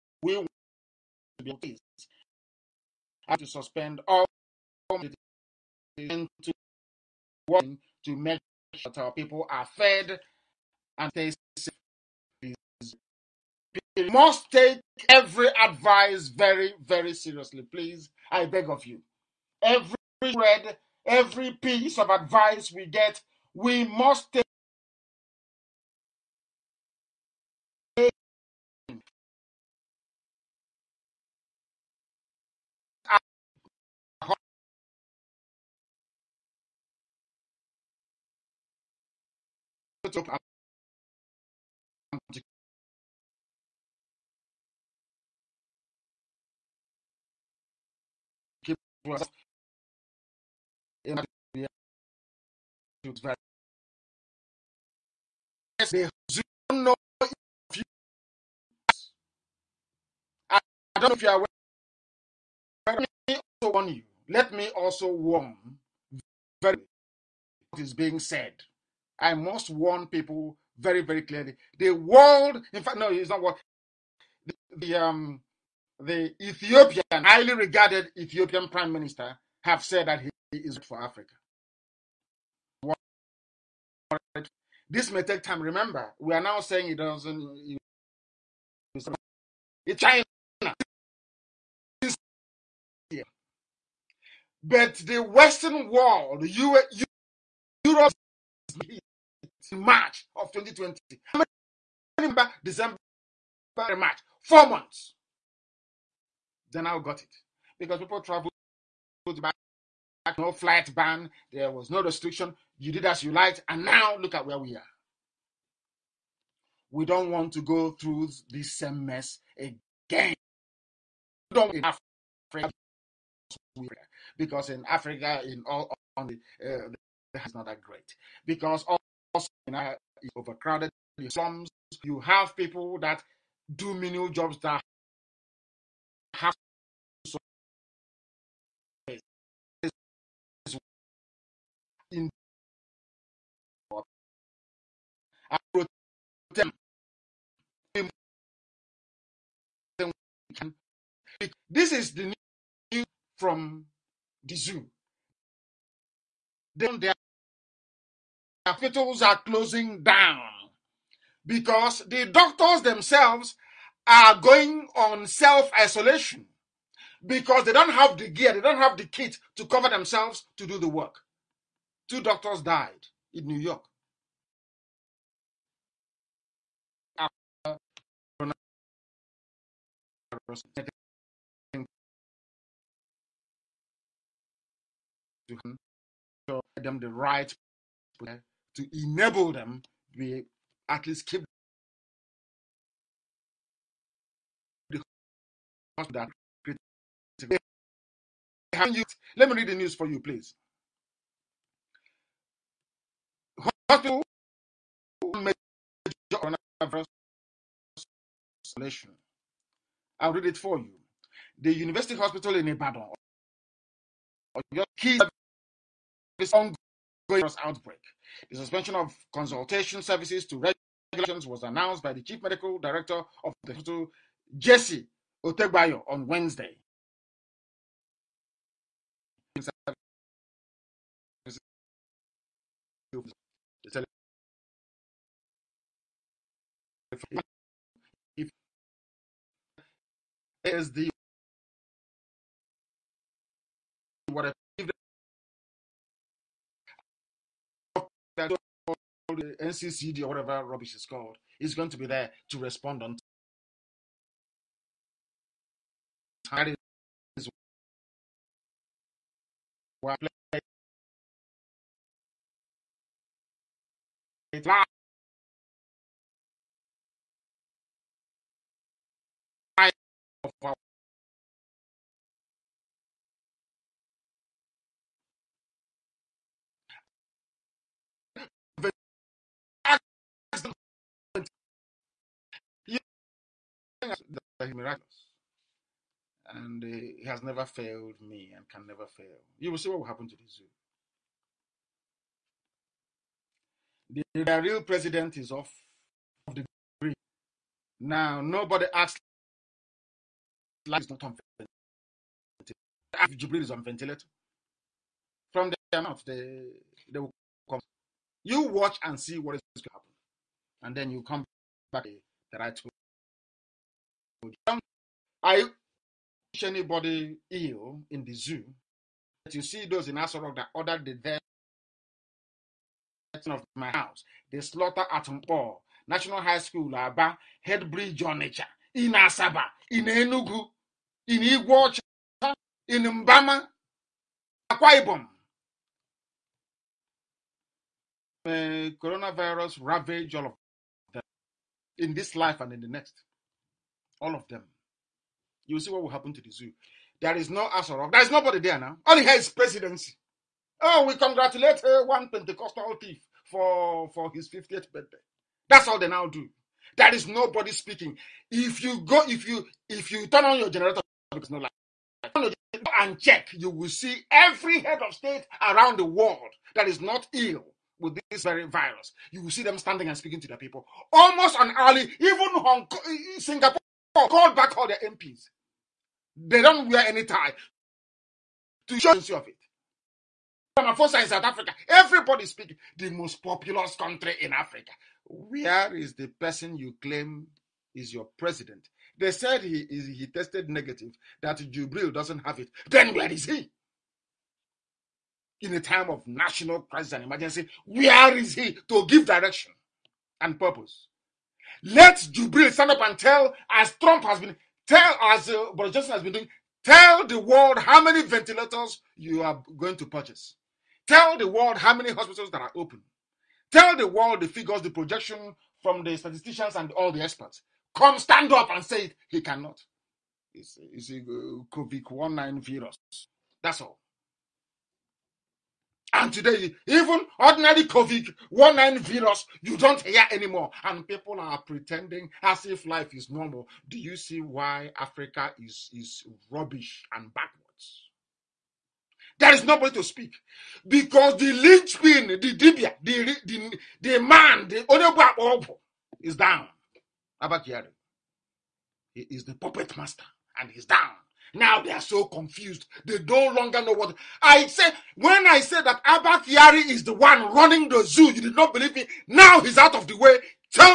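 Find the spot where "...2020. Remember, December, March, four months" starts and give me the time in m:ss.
1:40.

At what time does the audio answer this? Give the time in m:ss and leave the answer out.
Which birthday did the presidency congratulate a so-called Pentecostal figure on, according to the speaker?
5:54.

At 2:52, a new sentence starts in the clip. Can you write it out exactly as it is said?
Two doctors died in New York.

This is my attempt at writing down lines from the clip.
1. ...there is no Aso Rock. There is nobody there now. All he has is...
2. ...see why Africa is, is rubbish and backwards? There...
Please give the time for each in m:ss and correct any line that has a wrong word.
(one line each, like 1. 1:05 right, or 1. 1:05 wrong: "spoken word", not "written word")
1. 5:47 right
2. 7:14 right.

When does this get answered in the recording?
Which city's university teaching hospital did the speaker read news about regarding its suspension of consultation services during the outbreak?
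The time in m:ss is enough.
3:32.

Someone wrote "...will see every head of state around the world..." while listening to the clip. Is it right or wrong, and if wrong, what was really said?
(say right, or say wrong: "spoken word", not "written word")
right.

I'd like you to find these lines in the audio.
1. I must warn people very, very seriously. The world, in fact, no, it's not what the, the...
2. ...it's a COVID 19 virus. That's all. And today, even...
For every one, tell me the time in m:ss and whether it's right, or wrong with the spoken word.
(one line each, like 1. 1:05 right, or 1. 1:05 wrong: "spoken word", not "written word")
1. 1:09 wrong: "clearly", not "seriously"
2. 7:00 right.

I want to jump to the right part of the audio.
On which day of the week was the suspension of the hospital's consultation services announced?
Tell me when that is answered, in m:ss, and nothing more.
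3:46.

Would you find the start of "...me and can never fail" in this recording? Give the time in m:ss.
4:48.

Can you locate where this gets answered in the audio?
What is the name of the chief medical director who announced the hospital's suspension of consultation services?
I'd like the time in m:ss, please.
3:44.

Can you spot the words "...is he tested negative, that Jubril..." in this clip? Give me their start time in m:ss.
6:29.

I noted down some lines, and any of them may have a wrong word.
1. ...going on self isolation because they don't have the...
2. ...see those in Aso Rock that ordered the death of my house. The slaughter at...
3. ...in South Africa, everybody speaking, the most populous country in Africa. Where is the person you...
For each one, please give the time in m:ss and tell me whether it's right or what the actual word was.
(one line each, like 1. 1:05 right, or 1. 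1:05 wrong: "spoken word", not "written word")
1. 2:44 right
2. 5:19 right
3. 6:21 right.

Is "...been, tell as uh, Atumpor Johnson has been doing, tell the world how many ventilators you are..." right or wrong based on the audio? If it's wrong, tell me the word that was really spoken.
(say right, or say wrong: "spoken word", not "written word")
wrong: "Boris", not "Atumpor".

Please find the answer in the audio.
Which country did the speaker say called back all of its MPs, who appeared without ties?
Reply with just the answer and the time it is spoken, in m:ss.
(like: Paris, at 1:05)
Singapore, at 6:13.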